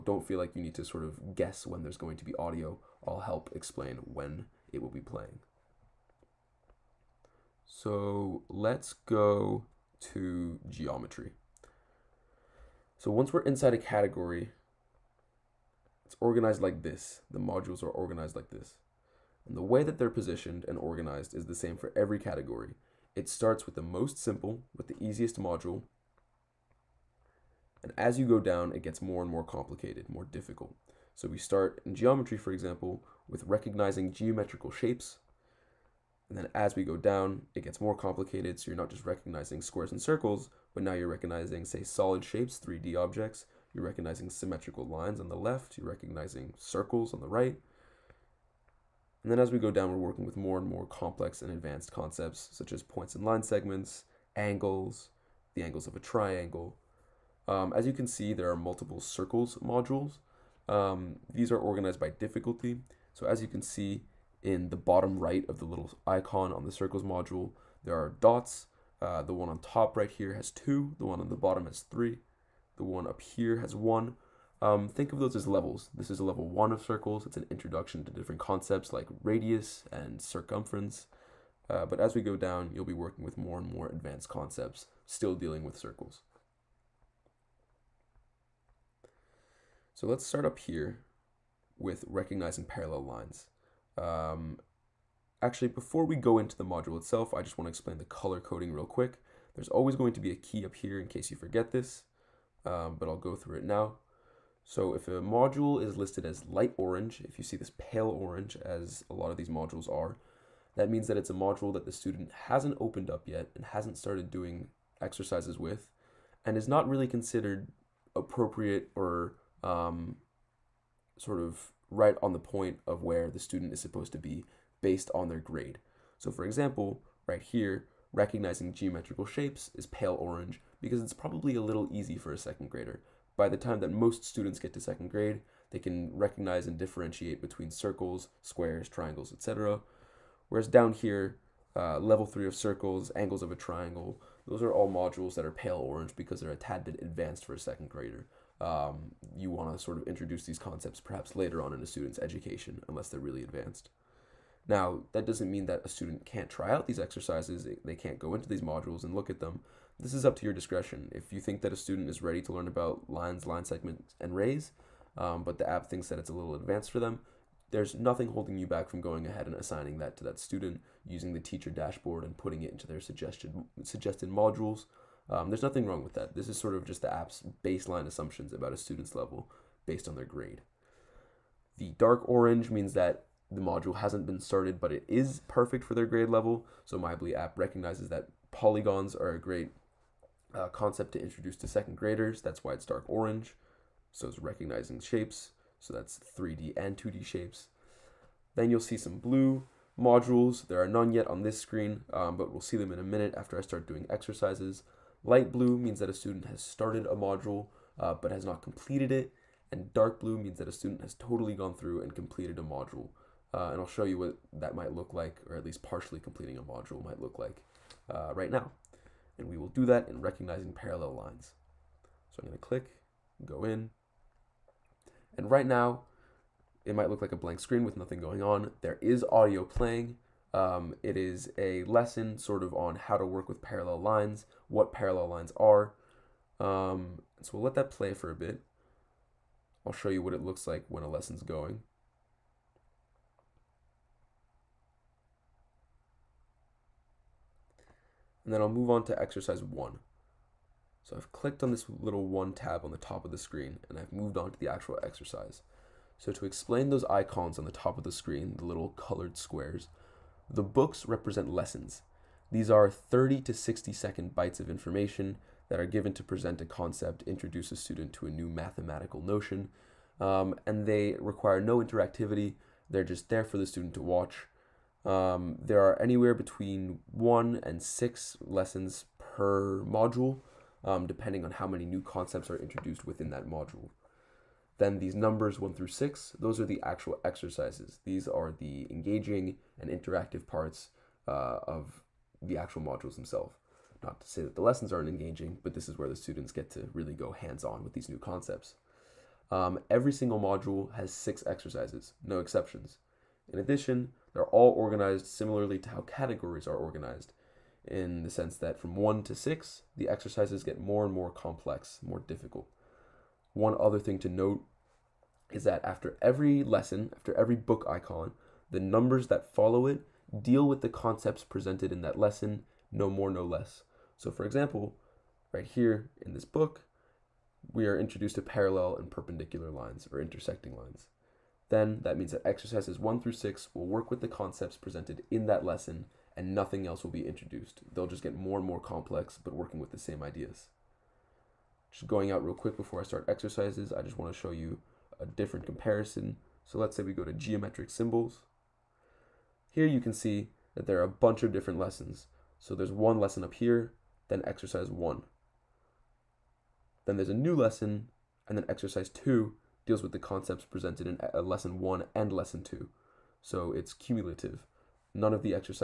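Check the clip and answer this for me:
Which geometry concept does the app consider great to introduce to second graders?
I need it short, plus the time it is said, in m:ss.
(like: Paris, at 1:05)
polygons, at 3:08.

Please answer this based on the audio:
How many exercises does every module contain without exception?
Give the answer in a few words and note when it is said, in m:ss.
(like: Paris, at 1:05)
6, at 5:01.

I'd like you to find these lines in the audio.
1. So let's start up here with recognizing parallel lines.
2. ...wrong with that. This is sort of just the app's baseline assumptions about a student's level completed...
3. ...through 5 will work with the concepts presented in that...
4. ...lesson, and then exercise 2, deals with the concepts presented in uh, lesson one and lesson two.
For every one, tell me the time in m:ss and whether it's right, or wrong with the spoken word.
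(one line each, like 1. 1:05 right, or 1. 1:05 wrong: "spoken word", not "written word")
1. 1:29 right
2. 2:55 wrong: "based", not "completed"
3. 5:33 wrong: "6", not "5"
4. 5:57 right.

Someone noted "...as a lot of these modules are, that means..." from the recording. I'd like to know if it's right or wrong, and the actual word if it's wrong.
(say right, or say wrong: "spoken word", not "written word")
right.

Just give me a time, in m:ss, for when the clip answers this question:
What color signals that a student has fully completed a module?
3:29.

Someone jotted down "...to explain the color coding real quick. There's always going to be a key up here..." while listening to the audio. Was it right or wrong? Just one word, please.
right.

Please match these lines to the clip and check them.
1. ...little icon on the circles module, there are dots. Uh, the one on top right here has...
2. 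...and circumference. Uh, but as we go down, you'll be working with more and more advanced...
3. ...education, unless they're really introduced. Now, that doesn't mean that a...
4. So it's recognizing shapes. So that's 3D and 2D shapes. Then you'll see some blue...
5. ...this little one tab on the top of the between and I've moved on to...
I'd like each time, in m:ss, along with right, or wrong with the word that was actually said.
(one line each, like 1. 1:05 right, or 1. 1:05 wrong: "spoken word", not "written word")
1. 1:05 right
2. 1:19 right
3. 2:32 wrong: "advanced", not "introduced"
4. 3:14 right
5. 4:11 wrong: "screen", not "between".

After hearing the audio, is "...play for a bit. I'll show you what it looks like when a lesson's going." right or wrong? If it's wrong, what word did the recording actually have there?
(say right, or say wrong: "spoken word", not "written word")
right.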